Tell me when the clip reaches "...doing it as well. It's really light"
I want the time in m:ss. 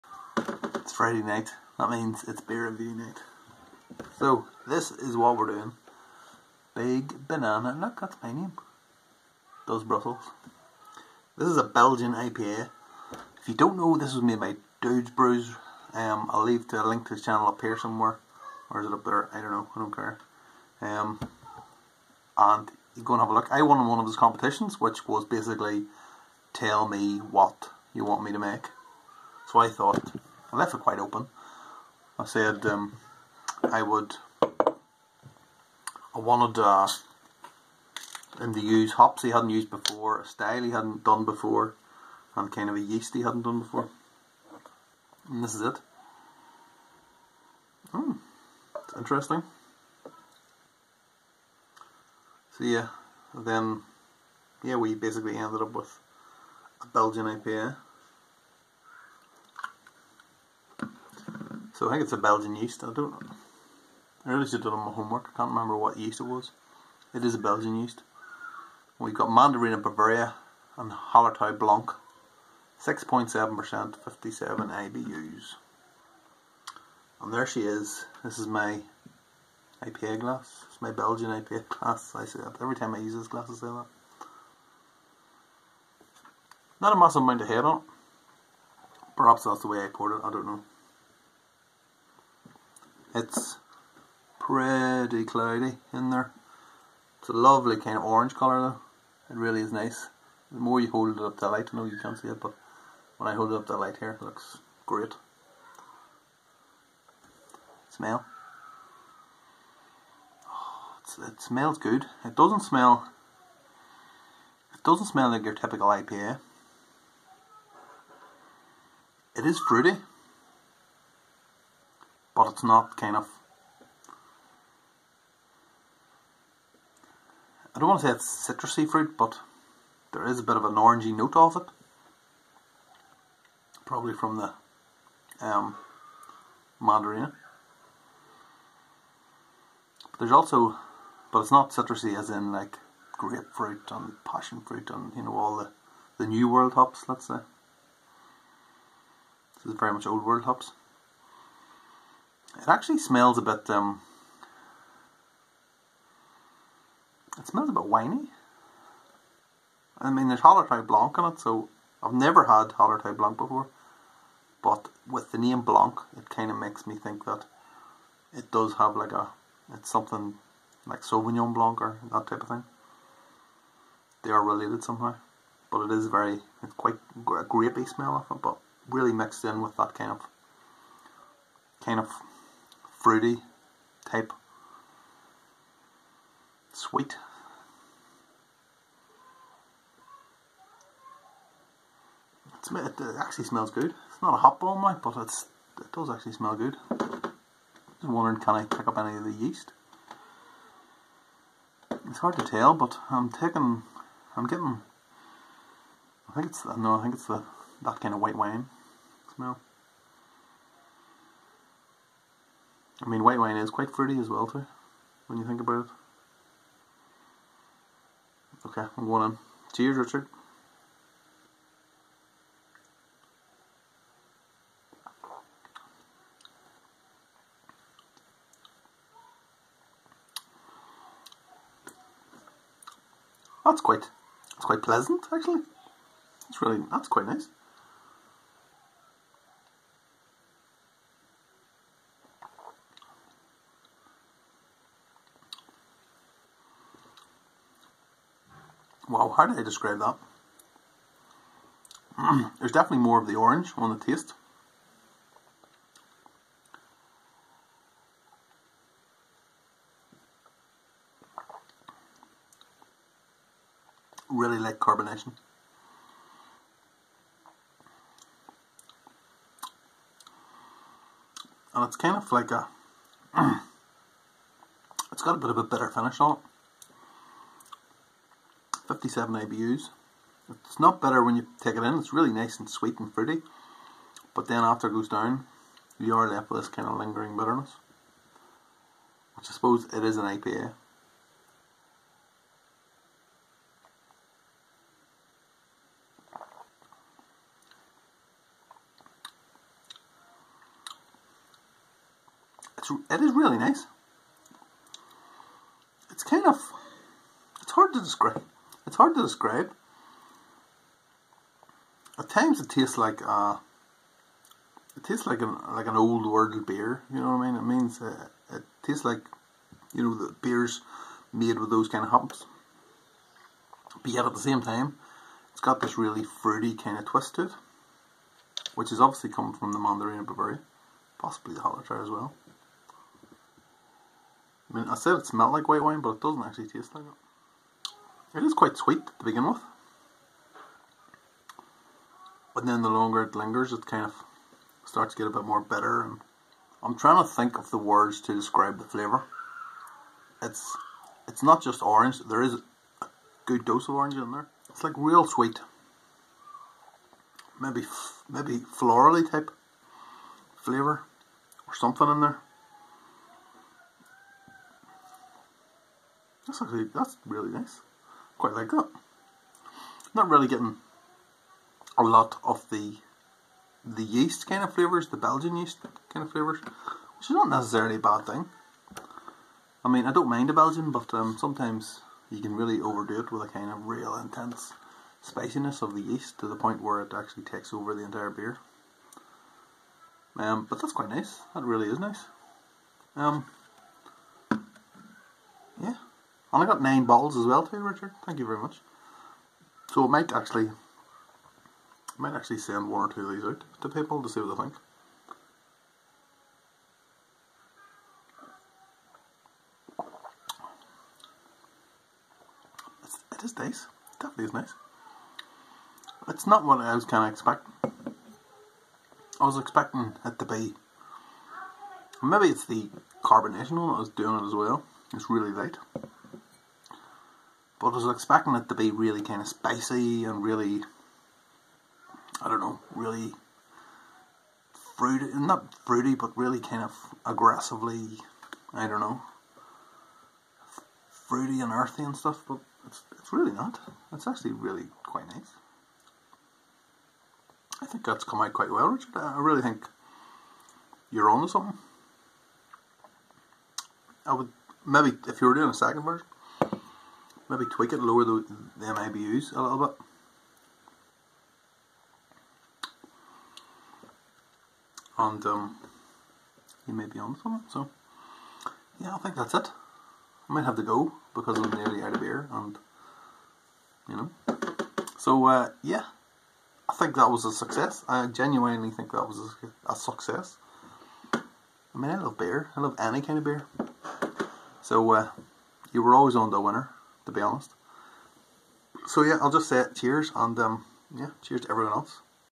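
7:04.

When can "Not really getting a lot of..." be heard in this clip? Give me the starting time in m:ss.
6:10.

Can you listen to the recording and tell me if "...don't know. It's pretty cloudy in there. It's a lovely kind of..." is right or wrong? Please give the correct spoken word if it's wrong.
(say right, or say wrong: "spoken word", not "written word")
right.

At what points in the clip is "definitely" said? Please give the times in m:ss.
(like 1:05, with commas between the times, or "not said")
4:12, 6:54.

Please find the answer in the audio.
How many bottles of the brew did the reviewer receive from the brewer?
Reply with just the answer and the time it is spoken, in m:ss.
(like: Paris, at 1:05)
9, at 6:36.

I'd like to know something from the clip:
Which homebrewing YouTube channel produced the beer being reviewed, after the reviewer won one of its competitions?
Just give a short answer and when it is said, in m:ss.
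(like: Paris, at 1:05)
Dude's Brews, at 0:14.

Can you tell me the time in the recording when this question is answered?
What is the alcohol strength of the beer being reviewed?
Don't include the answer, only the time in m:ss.
1:12.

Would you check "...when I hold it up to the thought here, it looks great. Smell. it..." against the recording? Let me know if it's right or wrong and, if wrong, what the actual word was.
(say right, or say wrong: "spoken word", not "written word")
wrong: "light", not "thought".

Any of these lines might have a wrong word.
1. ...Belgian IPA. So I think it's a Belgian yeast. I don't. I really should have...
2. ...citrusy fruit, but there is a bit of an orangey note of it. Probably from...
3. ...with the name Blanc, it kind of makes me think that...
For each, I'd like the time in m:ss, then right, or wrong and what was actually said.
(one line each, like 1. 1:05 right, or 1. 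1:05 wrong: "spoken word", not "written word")
1. 0:56 right
2. 2:08 right
3. 2:45 right.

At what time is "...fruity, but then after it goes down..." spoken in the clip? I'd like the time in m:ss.
4:43.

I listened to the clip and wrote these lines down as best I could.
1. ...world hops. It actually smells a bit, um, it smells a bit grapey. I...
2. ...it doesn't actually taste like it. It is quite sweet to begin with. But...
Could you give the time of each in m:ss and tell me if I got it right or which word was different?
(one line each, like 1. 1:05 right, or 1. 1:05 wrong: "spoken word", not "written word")
1. 2:30 wrong: "winey", not "grapey"
2. 5:36 right.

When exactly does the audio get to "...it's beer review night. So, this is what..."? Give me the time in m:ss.
0:02.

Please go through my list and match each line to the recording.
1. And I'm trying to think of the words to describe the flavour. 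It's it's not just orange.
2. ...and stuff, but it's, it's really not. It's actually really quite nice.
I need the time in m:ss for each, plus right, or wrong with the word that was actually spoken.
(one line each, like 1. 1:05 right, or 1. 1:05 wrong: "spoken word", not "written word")
1. 5:46 right
2. 7:22 right.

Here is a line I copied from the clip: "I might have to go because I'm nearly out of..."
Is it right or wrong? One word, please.
right.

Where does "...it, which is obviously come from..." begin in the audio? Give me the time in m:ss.
5:27.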